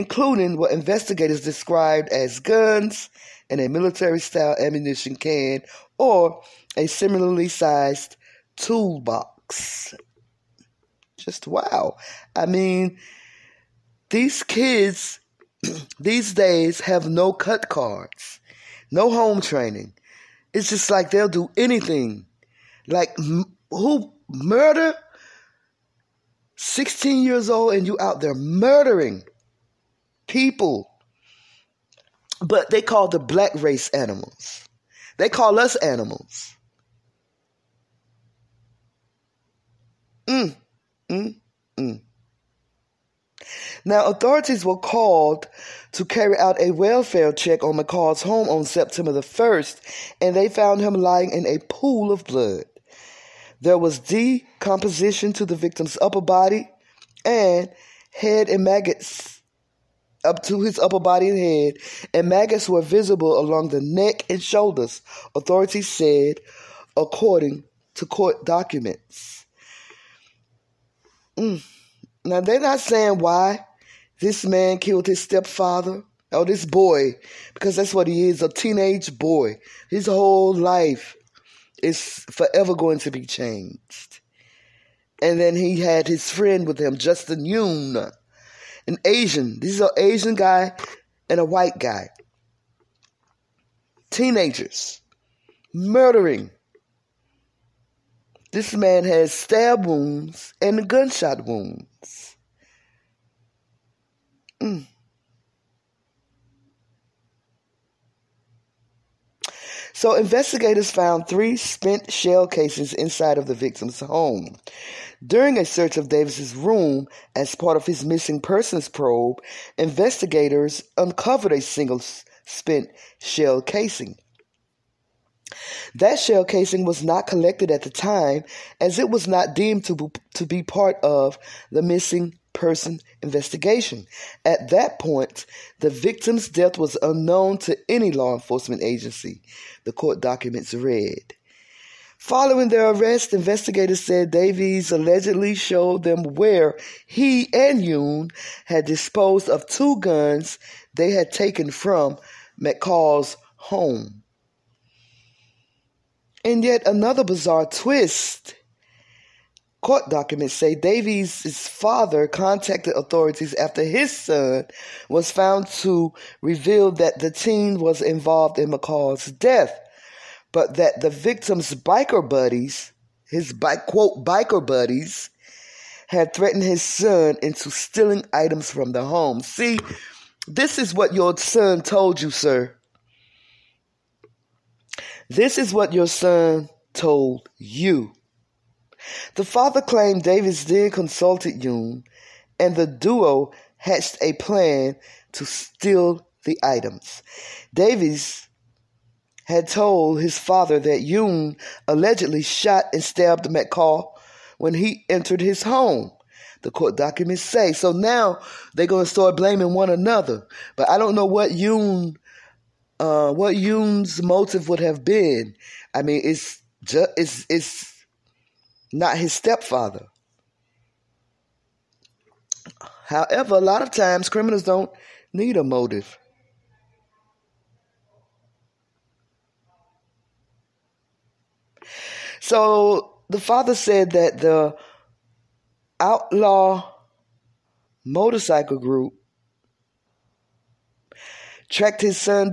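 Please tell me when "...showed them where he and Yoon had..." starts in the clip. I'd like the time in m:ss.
2:25.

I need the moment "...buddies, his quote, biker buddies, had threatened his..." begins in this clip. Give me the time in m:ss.
2:52.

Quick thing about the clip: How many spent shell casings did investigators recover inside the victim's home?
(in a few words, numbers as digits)
3.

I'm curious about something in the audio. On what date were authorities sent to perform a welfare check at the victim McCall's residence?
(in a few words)
September 1.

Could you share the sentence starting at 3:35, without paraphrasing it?
I mean, it's just, it's, it's not his stepfather.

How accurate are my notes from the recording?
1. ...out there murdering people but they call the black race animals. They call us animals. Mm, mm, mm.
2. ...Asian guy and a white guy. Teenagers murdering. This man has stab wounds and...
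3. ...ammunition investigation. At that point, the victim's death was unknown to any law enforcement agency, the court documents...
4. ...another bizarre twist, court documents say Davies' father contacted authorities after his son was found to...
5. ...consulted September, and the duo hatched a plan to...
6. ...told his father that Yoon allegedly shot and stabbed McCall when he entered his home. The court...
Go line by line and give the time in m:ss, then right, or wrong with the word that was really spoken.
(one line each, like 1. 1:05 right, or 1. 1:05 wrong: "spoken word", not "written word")
1. 0:27 right
2. 1:29 right
3. 2:12 wrong: "person", not "ammunition"
4. 2:36 right
5. 3:10 wrong: "Yoon", not "September"
6. 3:19 right.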